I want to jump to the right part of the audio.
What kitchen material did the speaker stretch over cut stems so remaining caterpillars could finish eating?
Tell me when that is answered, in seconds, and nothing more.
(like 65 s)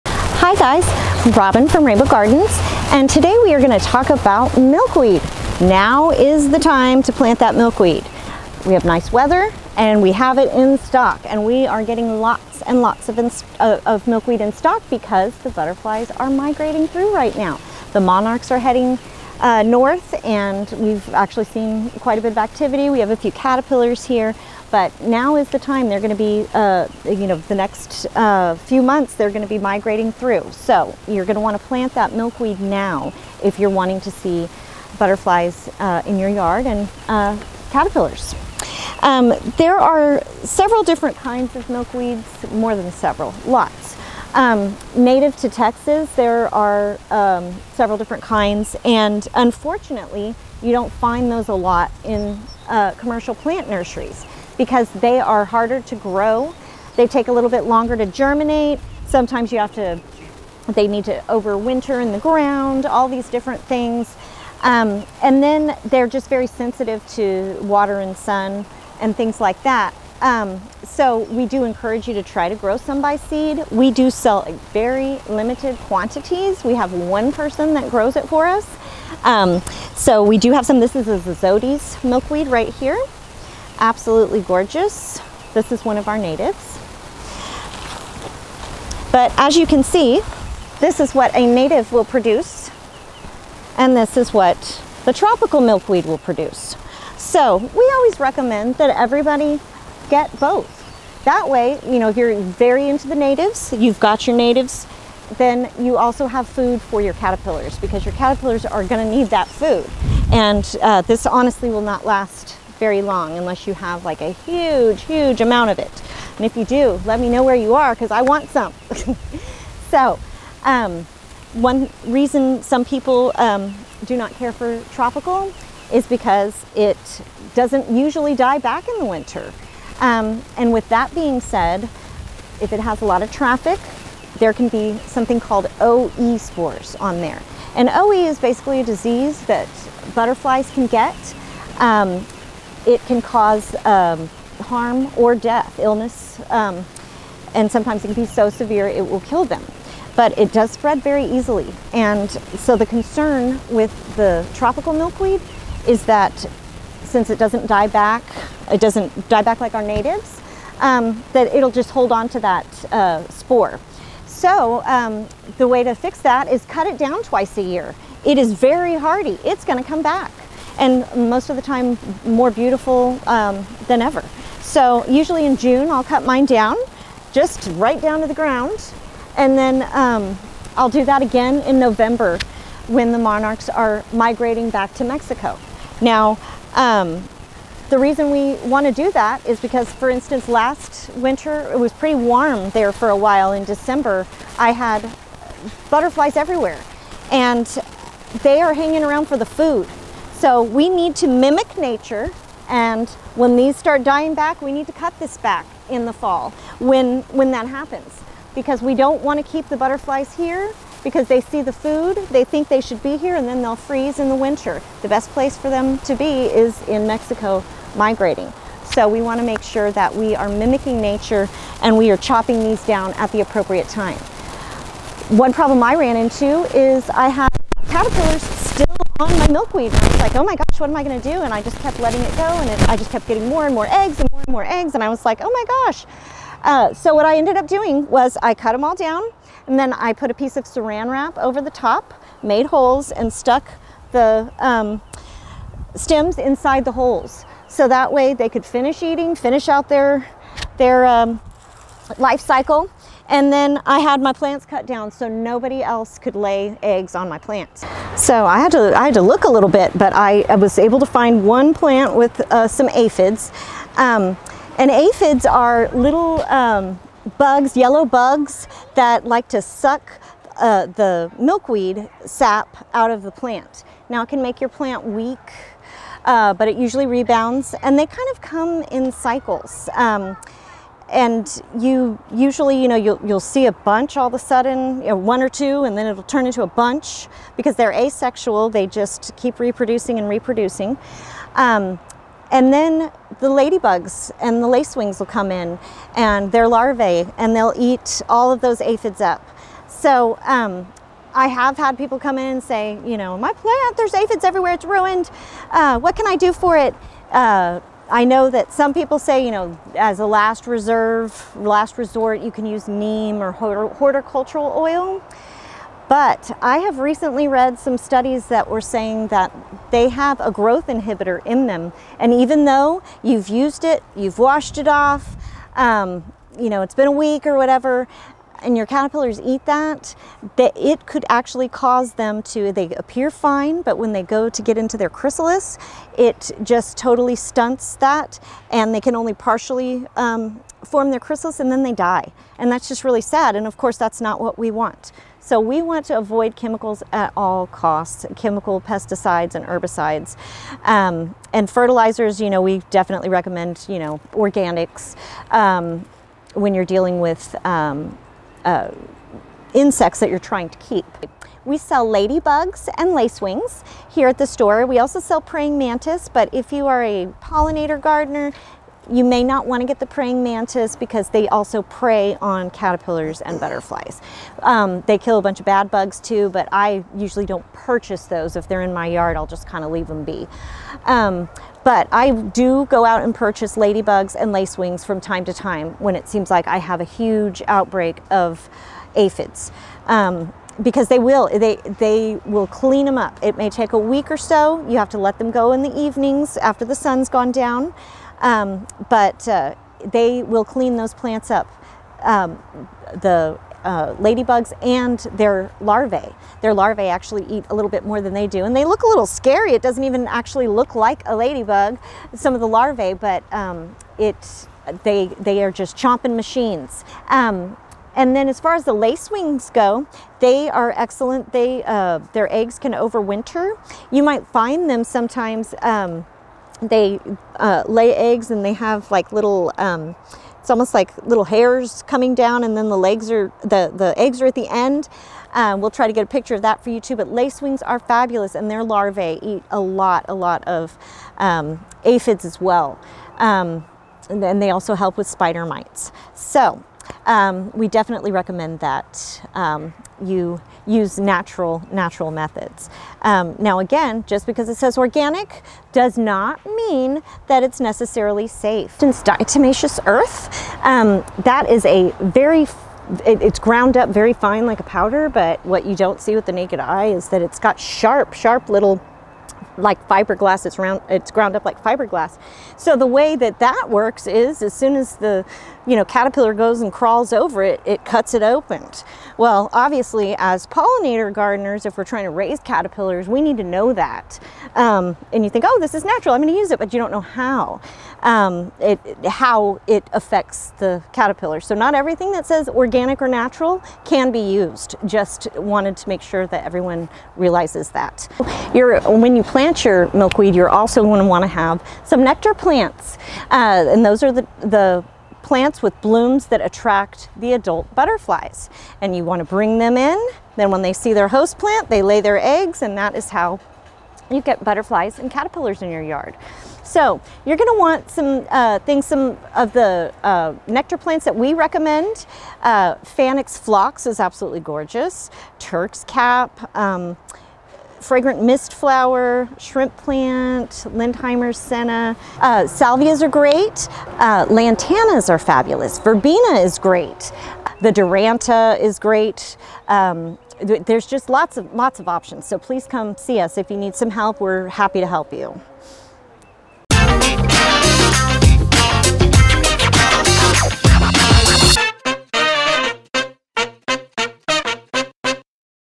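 240 s.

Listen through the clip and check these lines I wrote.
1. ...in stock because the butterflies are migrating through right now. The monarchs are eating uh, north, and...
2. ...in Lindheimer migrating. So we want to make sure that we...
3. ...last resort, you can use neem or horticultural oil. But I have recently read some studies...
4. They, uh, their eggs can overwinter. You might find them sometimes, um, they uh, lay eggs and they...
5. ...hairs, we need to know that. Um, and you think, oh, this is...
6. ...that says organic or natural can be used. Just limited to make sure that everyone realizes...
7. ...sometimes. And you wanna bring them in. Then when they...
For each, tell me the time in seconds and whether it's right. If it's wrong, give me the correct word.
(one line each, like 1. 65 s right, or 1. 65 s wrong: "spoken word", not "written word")
1. 14 s wrong: "heading", not "eating"
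2. 216 s wrong: "Mexico", not "Lindheimer"
3. 311 s right
4. 421 s right
5. 482 s wrong: "caterpillars", not "hairs"
6. 492 s wrong: "wanted", not "limited"
7. 507 s wrong: "butterflies", not "sometimes".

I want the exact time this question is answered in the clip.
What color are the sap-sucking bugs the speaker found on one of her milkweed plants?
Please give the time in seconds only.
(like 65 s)
267 s.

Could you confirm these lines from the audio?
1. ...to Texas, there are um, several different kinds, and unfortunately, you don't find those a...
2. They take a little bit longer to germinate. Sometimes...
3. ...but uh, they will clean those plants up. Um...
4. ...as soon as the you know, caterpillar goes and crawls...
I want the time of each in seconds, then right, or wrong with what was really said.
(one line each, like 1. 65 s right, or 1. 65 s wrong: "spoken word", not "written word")
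1. 45 s right
2. 56 s right
3. 399 s right
4. 474 s right.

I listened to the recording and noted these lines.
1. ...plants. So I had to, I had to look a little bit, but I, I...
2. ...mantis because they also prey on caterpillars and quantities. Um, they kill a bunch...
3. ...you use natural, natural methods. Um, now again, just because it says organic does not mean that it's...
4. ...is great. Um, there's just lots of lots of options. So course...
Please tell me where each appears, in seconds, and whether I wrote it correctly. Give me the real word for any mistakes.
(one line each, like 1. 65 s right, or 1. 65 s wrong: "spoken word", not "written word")
1. 257 s right
2. 370 s wrong: "butterflies", not "quantities"
3. 450 s right
4. 538 s wrong: "please", not "course".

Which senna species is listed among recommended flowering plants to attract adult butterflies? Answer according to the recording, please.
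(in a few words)
Lindheimer senna.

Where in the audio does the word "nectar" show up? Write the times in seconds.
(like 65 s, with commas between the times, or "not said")
502 s, 520 s.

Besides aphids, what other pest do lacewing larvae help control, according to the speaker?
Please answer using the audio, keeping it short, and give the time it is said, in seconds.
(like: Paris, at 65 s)
Spider mites, at 445 s.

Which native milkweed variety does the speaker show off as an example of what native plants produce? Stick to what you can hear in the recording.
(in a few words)
Zodi's milkweed.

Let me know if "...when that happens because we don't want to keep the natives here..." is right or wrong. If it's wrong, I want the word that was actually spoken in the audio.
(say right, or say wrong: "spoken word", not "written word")
wrong: "butterflies", not "natives".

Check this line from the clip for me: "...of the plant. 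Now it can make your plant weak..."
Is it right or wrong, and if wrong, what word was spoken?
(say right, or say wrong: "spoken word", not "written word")
right.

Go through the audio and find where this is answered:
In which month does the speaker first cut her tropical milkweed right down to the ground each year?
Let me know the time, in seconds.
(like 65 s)
175 s.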